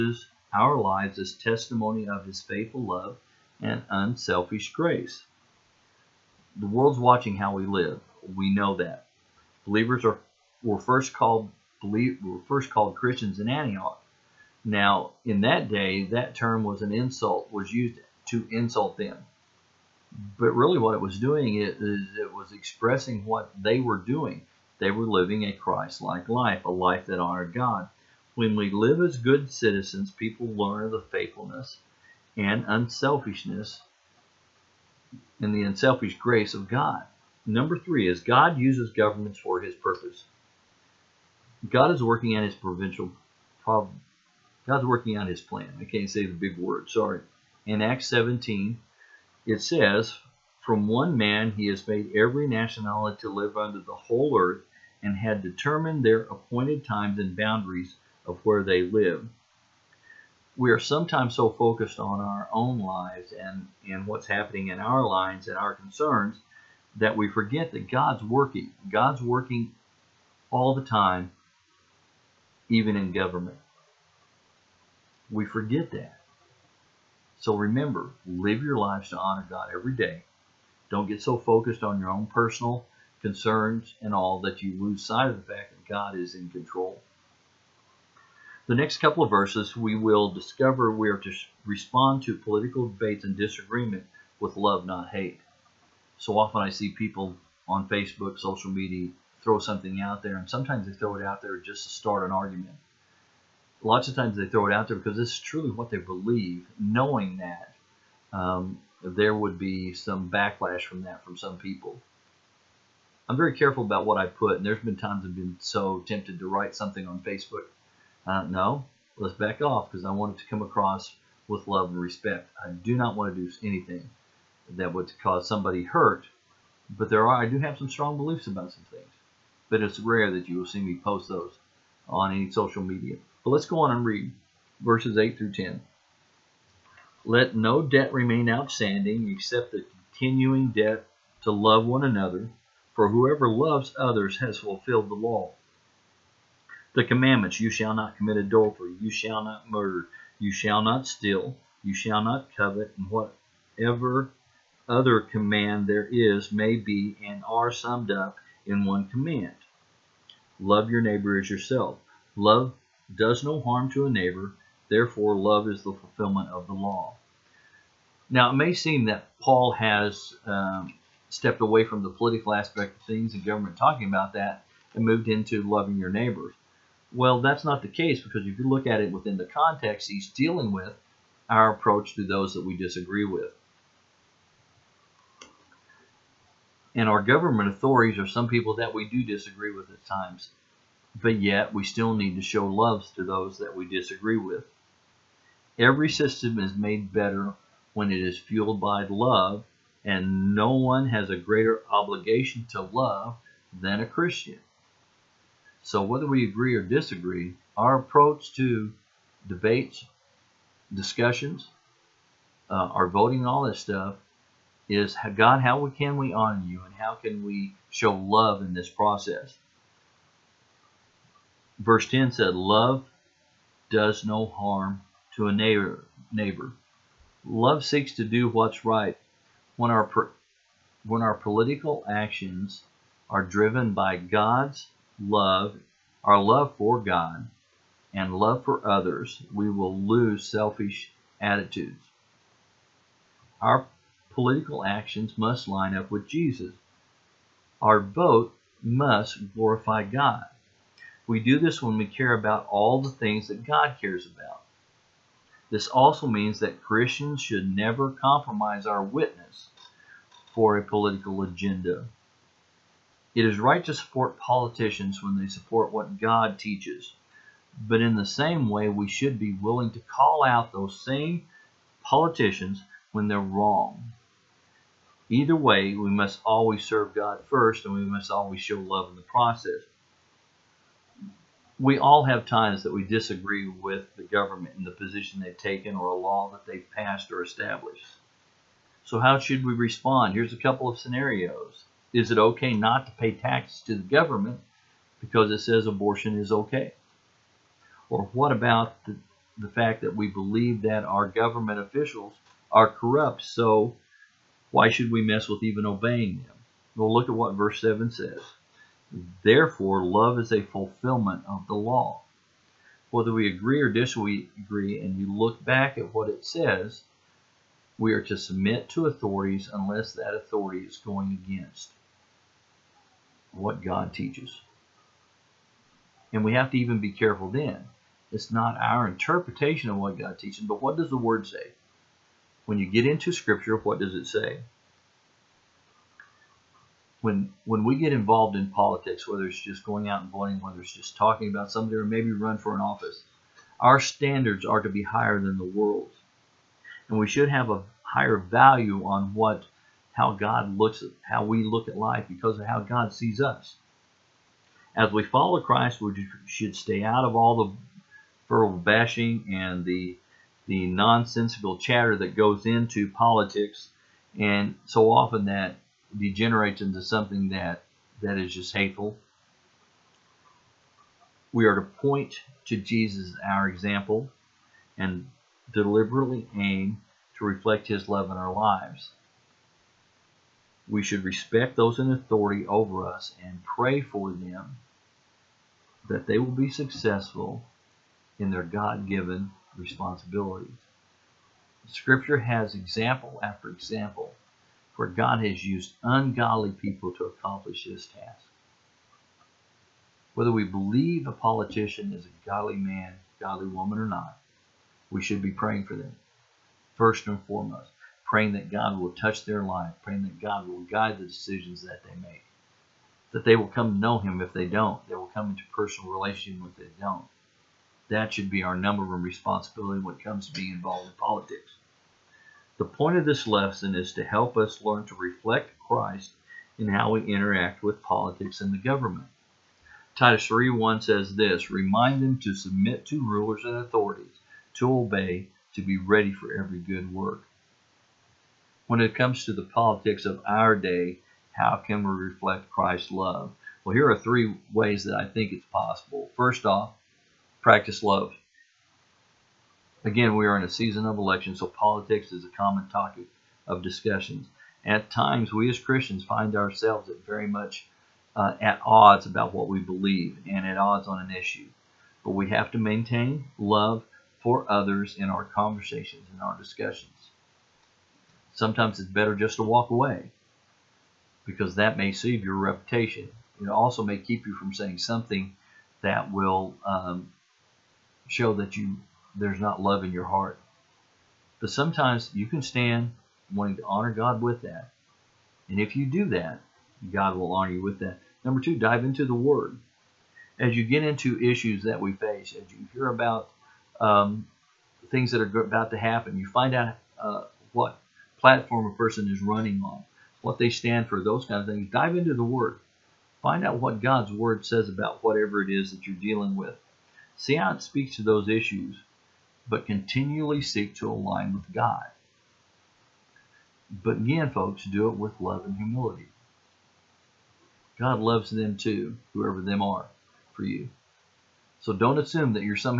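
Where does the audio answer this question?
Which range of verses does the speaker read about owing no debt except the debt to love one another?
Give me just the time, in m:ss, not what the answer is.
2:14.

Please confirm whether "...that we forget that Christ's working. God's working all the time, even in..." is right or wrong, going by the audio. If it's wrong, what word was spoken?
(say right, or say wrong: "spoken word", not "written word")
wrong: "God", not "Christ".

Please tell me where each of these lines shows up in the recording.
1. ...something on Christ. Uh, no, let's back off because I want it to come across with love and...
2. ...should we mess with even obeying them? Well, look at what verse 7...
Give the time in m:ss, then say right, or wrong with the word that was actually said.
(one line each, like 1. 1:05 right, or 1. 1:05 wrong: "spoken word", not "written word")
1. 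1:56 wrong: "Facebook", not "Christ"
2. 5:04 right.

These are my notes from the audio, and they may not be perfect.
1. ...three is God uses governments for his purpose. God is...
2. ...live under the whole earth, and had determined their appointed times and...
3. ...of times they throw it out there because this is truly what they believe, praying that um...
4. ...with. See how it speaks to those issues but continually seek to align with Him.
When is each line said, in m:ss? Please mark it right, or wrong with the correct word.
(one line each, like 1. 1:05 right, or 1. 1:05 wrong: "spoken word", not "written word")
1. 0:37 right
2. 0:53 right
3. 1:44 wrong: "knowing", not "praying"
4. 8:26 wrong: "God", not "Him".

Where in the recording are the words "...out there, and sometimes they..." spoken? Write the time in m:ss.
1:40.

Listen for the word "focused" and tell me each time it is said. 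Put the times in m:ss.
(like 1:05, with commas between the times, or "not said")
1:01, 1:21.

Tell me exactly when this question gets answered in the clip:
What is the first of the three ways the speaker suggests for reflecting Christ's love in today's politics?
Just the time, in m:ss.
7:27.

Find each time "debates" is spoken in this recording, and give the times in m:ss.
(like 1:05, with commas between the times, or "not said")
1:32, 3:29.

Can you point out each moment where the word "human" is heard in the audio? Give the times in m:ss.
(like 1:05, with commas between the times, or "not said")
not said.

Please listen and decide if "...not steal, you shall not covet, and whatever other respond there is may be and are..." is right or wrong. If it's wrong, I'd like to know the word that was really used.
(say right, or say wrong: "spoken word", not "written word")
wrong: "command", not "respond".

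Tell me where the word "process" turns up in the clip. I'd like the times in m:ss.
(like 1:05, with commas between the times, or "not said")
3:38, 4:39.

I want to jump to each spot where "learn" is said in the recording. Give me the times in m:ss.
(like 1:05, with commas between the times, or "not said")
0:30, 7:04.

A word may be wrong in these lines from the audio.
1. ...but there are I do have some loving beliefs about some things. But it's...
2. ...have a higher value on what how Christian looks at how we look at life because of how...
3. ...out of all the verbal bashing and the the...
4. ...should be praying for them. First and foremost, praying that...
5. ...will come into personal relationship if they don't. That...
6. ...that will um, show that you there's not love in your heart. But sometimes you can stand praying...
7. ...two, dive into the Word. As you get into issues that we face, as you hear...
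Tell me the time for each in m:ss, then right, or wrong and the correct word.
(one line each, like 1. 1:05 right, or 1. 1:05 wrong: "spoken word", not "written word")
1. 2:06 wrong: "strong", not "loving"
2. 5:47 wrong: "God", not "Christian"
3. 5:57 right
4. 6:45 right
5. 6:55 right
6. 7:56 wrong: "wanting", not "praying"
7. 8:08 right.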